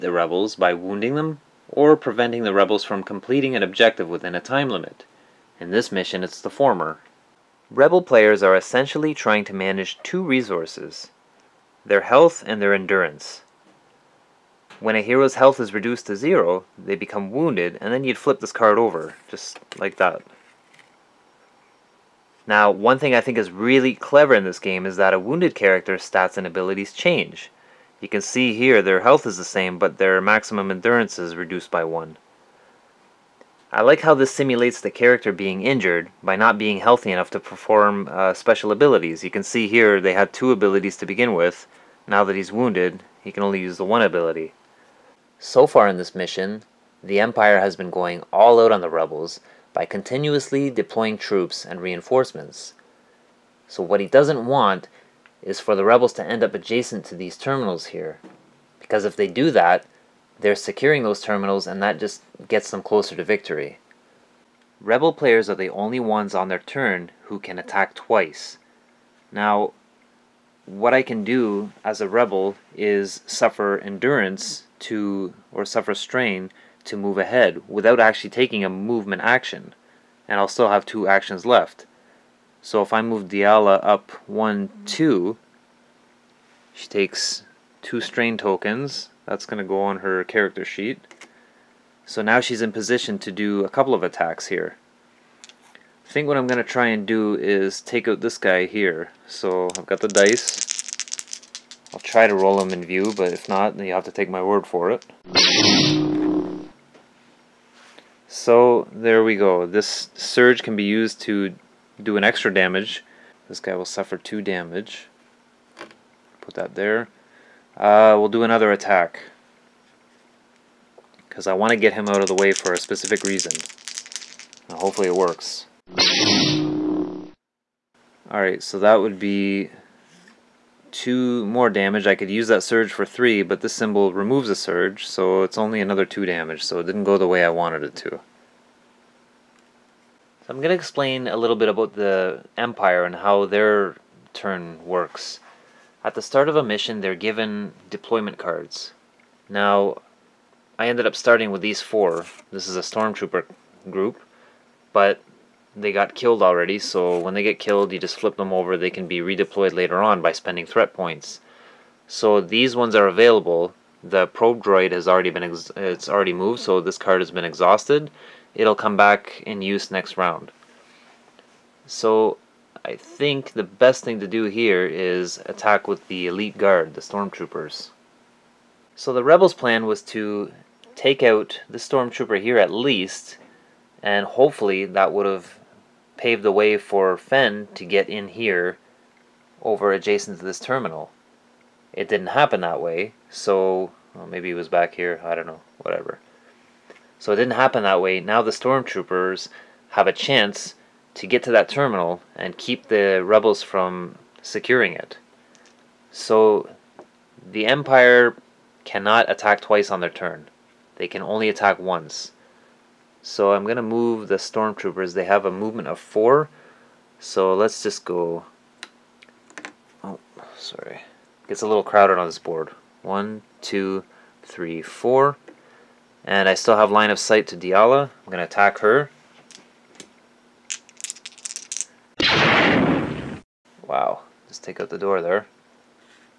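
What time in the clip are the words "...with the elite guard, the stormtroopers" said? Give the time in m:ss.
2:55.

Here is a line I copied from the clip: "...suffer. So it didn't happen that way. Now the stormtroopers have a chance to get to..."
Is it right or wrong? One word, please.
wrong.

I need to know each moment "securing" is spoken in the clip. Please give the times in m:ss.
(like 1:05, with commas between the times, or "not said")
1:00, 3:24.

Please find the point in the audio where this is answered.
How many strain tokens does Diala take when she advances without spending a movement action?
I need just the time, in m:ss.
1:26.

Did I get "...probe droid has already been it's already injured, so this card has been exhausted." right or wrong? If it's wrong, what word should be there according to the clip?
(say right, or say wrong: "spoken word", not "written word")
wrong: "moved", not "injured".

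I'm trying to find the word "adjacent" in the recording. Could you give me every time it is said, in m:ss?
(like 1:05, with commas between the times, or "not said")
0:56, 3:09.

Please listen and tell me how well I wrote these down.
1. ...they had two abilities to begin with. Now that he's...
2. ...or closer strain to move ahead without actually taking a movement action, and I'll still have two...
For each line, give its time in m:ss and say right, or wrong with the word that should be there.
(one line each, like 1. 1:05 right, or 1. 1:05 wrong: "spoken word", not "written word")
1. 0:39 right
2. 1:15 wrong: "suffer", not "closer".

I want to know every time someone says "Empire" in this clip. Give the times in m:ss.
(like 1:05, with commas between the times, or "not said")
0:47, 2:22, 3:27.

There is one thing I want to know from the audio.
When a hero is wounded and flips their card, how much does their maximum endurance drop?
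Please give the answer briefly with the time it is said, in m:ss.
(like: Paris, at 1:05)
1, at 0:31.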